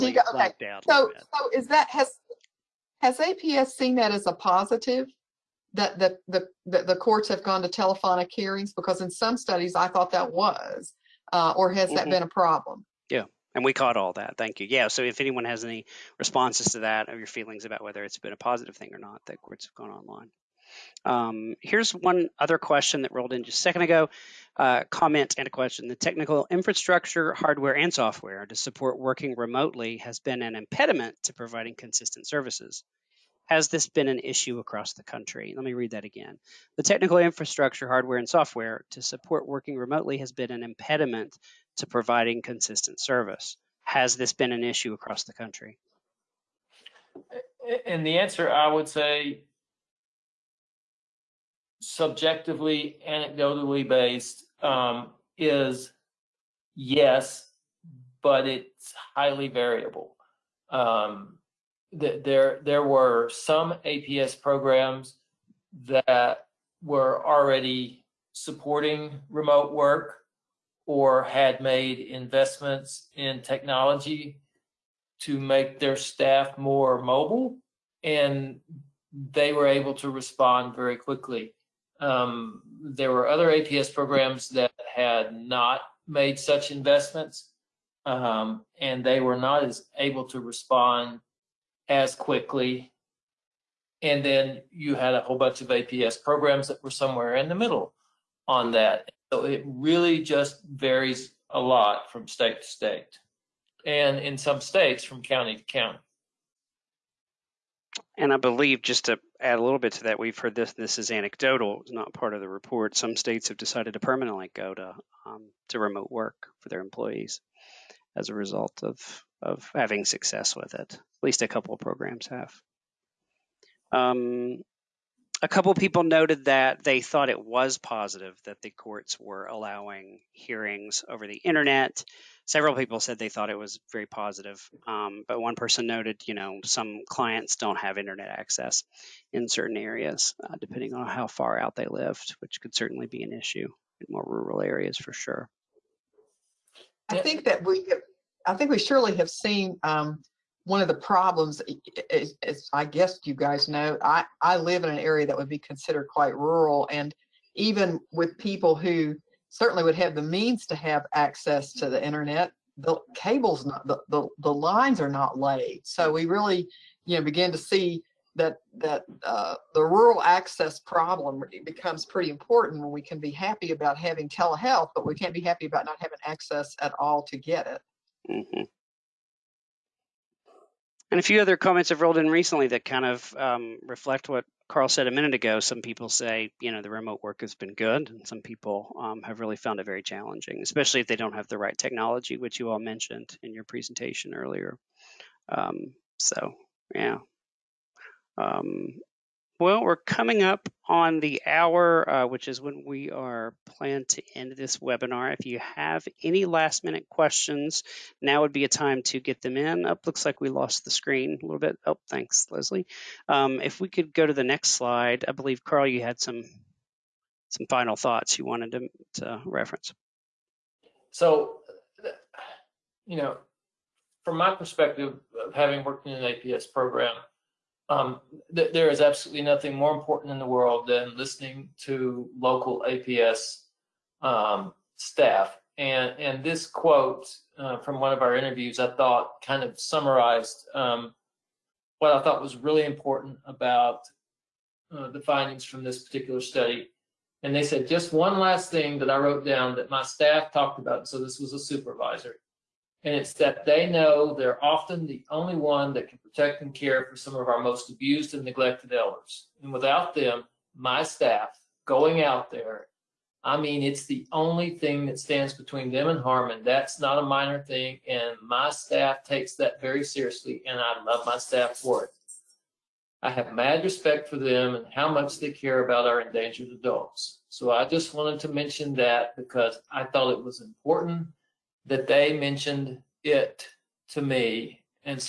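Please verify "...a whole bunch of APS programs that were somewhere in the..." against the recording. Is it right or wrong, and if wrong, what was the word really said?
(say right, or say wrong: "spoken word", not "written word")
right.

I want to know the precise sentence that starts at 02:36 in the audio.
And even with people who certainly would have the means to have access to the internet.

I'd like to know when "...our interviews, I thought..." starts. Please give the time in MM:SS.
03:58.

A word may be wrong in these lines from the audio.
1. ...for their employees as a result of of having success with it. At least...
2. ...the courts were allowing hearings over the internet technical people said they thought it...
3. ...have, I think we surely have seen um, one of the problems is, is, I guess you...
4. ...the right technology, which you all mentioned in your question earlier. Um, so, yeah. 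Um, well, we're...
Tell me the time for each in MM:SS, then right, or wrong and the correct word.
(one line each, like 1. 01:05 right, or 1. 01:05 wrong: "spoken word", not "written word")
1. 01:56 right
2. 02:08 wrong: "several", not "technical"
3. 02:27 right
4. 03:11 wrong: "presentation", not "question".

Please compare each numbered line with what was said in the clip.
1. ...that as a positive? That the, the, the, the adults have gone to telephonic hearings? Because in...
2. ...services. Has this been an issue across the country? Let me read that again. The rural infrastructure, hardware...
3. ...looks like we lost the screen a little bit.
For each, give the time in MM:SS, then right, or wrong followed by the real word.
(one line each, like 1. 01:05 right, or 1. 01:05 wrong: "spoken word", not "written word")
1. 00:03 wrong: "courts", not "adults"
2. 00:32 wrong: "technical", not "rural"
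3. 03:30 right.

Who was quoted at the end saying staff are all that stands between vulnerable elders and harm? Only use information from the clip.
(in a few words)
A supervisor.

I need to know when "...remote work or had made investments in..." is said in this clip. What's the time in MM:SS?
01:09.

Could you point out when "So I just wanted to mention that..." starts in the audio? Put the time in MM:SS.
04:37.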